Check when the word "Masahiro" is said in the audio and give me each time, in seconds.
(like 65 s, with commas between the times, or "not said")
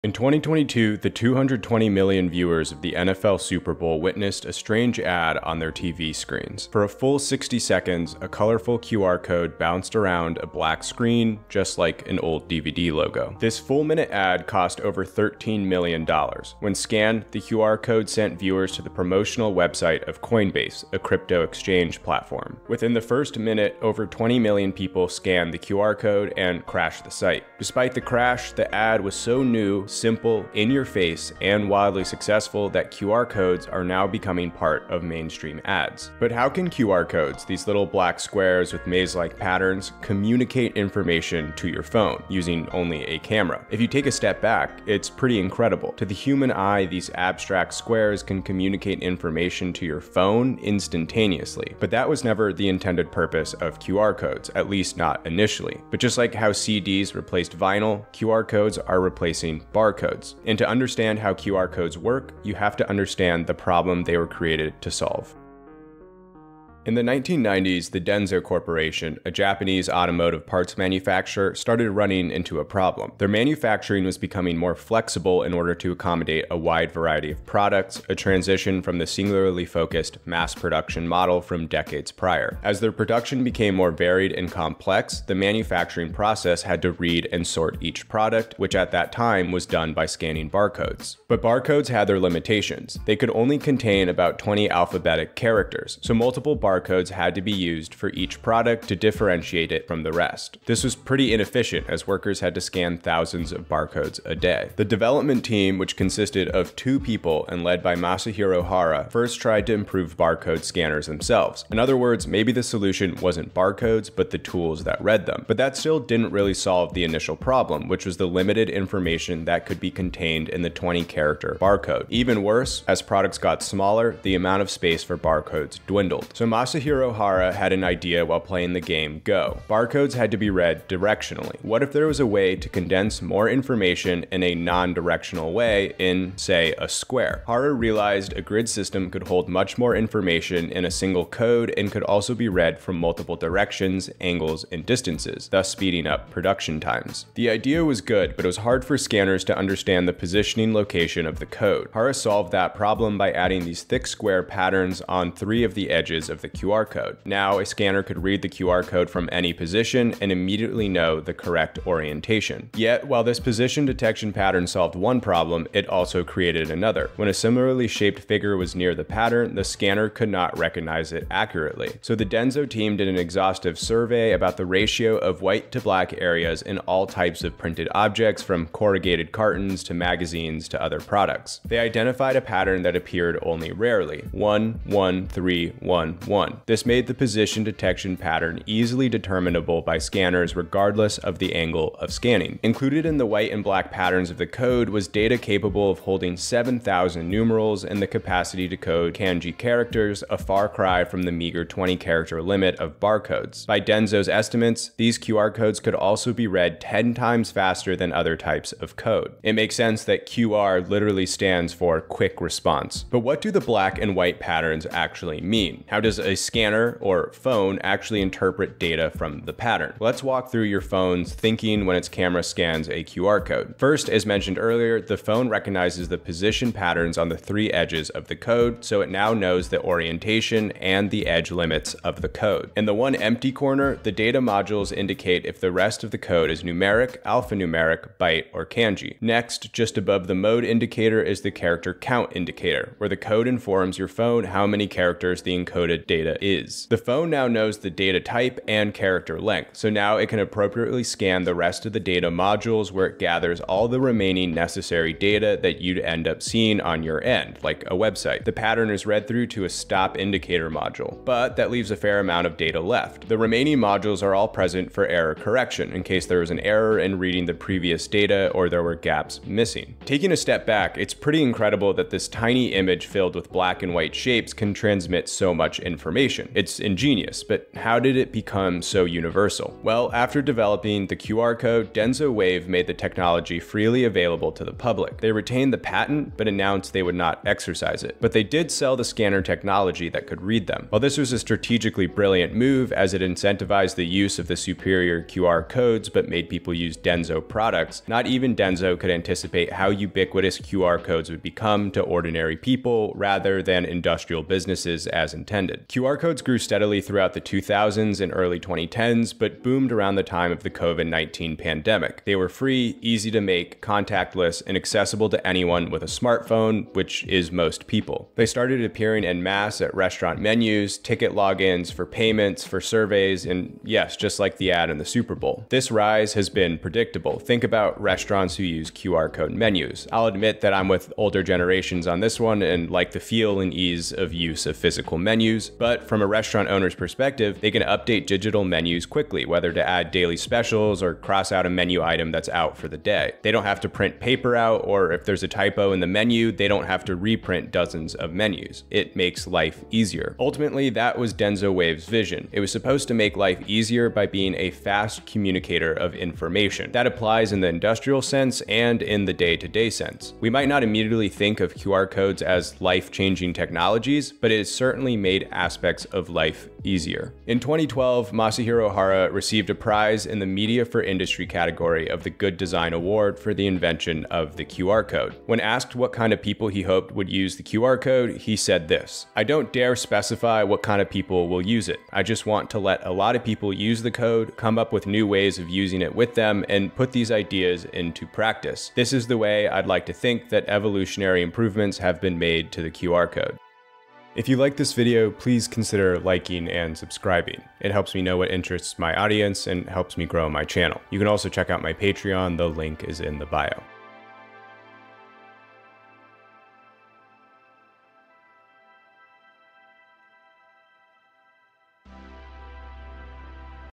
107 s, 126 s, 368 s.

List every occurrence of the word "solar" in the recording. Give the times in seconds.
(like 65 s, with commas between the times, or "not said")
not said.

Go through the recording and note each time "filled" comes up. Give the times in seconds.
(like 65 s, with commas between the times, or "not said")
273 s.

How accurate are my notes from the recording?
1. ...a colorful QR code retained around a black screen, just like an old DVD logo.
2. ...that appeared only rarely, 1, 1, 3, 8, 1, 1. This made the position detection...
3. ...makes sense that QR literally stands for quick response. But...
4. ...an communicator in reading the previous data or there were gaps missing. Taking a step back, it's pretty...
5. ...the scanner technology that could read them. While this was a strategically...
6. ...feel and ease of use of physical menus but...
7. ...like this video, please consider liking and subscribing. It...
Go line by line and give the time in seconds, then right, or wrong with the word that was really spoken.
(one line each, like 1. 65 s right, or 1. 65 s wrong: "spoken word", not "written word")
1. 8 s wrong: "bounced", not "retained"
2. 182 s wrong: "1", not "8"
3. 209 s right
4. 266 s wrong: "error", not "communicator"
5. 288 s right
6. 333 s right
7. 394 s right.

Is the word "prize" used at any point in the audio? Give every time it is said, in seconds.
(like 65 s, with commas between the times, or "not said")
369 s.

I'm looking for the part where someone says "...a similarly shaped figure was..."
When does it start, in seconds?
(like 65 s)
167 s.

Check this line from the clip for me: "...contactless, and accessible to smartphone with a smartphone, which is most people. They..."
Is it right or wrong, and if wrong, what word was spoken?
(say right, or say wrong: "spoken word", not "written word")
wrong: "anyone", not "smartphone".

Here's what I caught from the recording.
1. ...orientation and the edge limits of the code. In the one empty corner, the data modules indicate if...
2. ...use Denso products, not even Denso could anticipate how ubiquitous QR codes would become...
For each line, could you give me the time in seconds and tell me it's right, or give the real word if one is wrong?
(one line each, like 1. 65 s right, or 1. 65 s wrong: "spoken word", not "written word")
1. 229 s right
2. 296 s right.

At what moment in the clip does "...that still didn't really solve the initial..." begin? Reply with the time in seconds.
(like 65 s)
115 s.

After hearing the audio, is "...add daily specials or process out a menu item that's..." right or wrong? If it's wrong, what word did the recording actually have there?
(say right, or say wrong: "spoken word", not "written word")
wrong: "cross", not "process".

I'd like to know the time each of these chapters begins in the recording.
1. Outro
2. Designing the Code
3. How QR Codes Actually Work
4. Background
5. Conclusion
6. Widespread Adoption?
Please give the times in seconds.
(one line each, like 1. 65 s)
1. 393 s
2. 125 s
3. 212 s
4. 66 s
5. 366 s
6. 279 s.